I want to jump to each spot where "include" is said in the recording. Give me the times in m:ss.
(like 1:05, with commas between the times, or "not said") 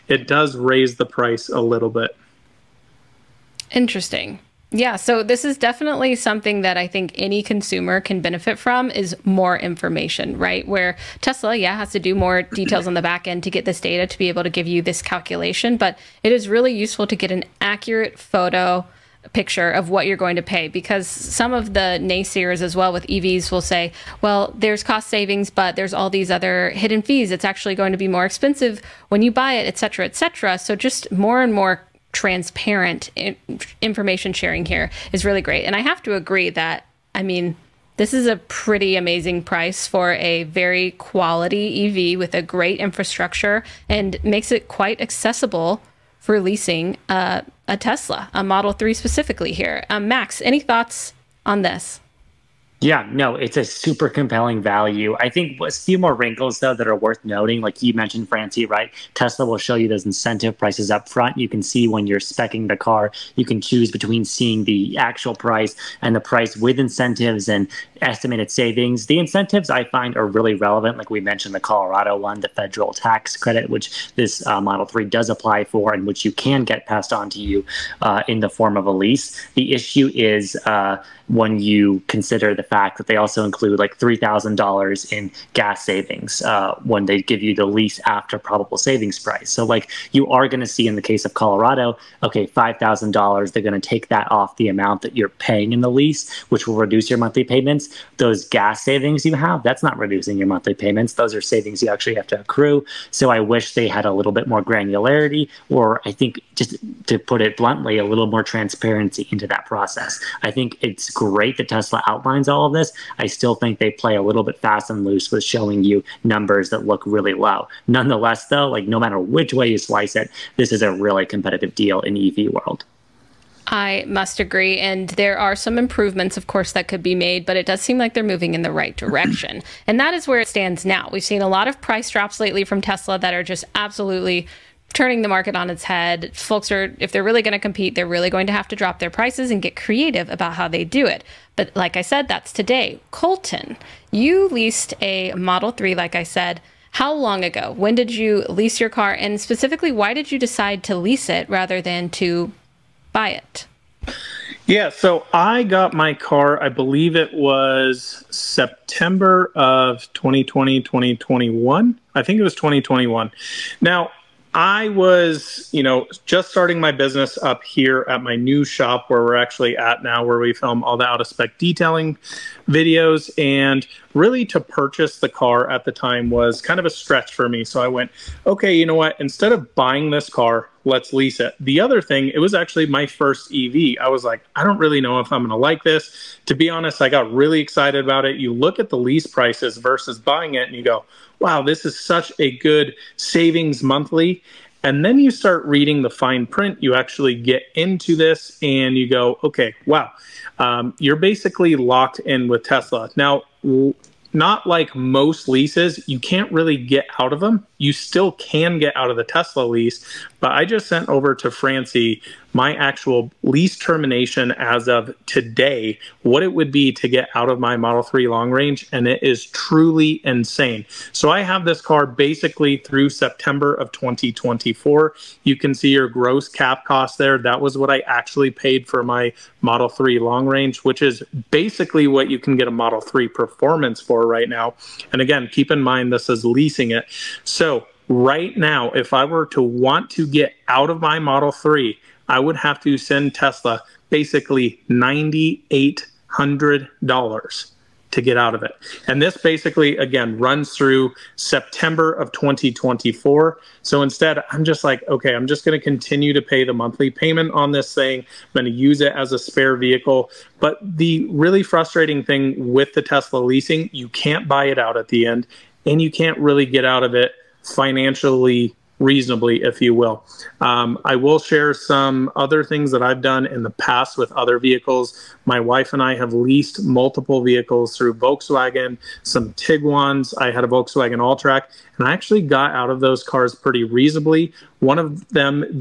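1:23.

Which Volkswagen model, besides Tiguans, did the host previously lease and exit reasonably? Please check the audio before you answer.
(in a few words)
Alltrack.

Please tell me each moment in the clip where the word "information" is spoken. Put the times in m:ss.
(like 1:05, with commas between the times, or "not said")
0:09, 0:33.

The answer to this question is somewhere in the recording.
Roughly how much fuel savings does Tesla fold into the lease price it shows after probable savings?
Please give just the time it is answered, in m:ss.
1:23.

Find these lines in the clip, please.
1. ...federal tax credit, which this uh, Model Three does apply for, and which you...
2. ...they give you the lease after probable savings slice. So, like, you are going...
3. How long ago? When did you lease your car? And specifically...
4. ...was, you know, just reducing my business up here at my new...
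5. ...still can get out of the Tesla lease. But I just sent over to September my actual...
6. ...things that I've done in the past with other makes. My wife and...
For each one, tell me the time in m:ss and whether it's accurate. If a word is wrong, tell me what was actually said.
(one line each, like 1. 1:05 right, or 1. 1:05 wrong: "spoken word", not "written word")
1. 1:12 right
2. 1:27 wrong: "price", not "slice"
3. 2:26 right
4. 2:44 wrong: "starting", not "reducing"
5. 3:27 wrong: "Francie", not "September"
6. 4:32 wrong: "vehicles", not "makes".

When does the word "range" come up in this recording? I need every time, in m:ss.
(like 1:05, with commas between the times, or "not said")
3:38, 3:50.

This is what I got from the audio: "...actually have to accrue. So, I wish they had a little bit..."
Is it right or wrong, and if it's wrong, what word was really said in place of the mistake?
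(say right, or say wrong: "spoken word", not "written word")
right.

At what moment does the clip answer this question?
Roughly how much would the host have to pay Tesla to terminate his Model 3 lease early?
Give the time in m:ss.
4:04.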